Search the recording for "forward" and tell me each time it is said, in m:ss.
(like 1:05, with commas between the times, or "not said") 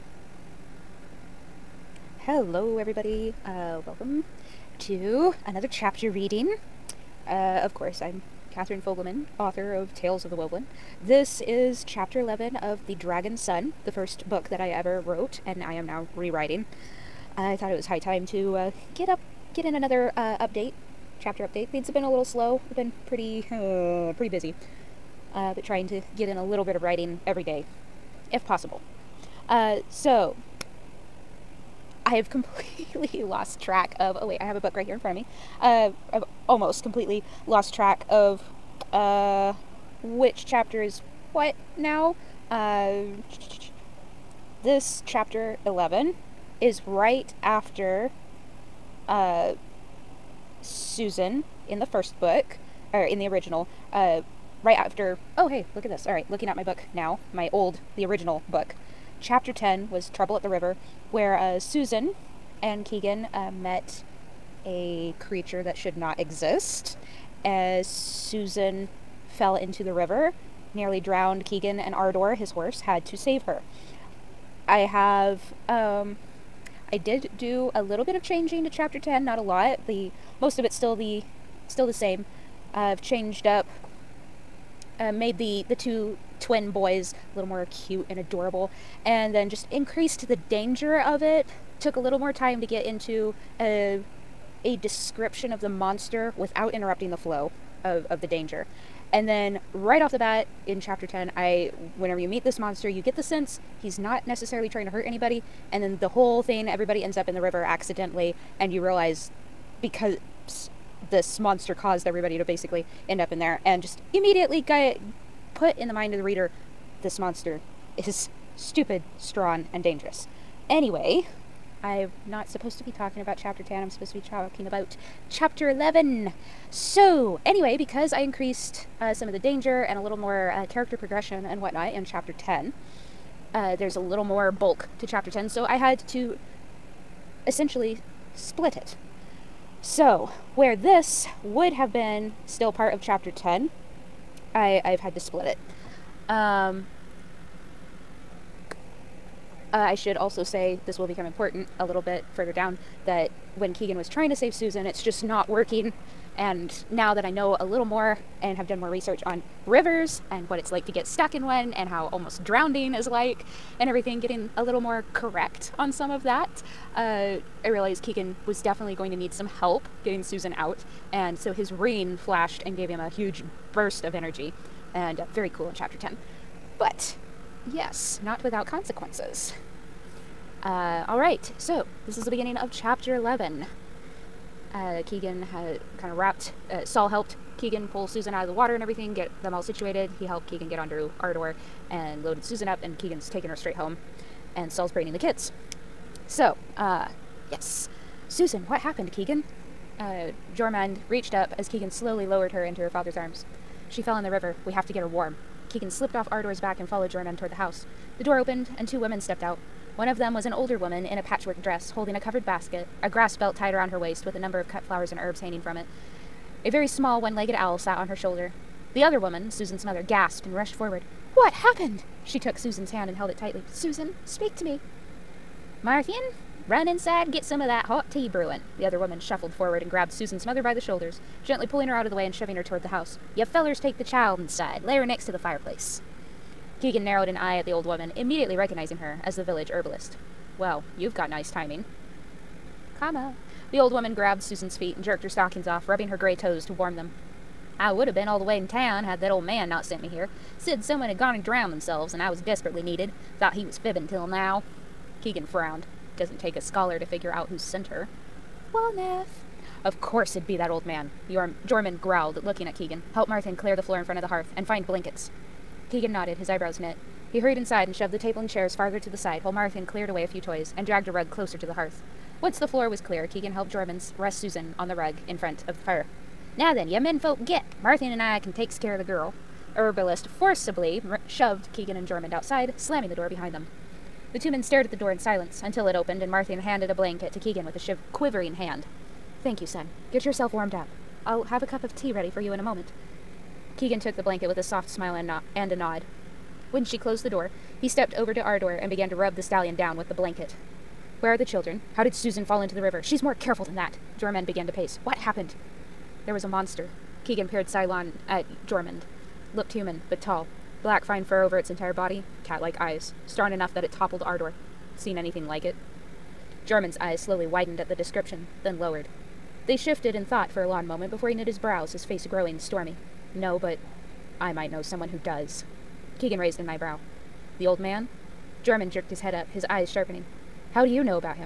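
3:40, 3:49.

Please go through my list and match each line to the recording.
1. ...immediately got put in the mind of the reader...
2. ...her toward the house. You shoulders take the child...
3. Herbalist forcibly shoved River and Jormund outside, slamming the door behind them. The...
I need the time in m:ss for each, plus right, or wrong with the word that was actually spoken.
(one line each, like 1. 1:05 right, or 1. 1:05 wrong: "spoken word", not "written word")
1. 1:54 right
2. 3:52 wrong: "fellers", not "shoulders"
3. 4:39 wrong: "Keegan", not "River".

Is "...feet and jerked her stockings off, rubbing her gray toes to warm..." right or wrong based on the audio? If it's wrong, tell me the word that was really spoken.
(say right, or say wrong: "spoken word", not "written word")
right.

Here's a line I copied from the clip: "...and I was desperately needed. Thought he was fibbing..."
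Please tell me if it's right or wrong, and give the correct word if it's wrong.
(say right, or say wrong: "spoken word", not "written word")
right.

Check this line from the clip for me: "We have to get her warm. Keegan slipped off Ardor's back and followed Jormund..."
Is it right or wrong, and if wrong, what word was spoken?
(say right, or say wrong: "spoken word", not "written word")
right.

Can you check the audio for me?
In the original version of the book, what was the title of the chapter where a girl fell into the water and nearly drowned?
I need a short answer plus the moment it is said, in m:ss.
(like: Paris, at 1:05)
Trouble at the River, at 1:00.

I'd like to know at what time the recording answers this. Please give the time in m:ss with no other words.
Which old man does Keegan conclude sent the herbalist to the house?
4:18.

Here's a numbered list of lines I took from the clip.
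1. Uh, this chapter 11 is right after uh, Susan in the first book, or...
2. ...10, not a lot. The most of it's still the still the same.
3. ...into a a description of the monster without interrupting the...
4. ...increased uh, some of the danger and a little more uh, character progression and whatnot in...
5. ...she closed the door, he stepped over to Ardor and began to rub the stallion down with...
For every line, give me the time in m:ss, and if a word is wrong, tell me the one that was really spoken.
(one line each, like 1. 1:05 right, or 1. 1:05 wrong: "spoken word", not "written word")
1. 0:42 right
2. 1:18 right
3. 1:32 right
4. 2:08 right
5. 4:56 right.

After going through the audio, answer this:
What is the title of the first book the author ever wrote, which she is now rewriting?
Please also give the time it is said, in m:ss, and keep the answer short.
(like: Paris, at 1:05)
The Dragon Son, at 0:12.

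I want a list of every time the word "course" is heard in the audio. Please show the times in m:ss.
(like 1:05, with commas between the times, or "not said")
0:07, 4:20.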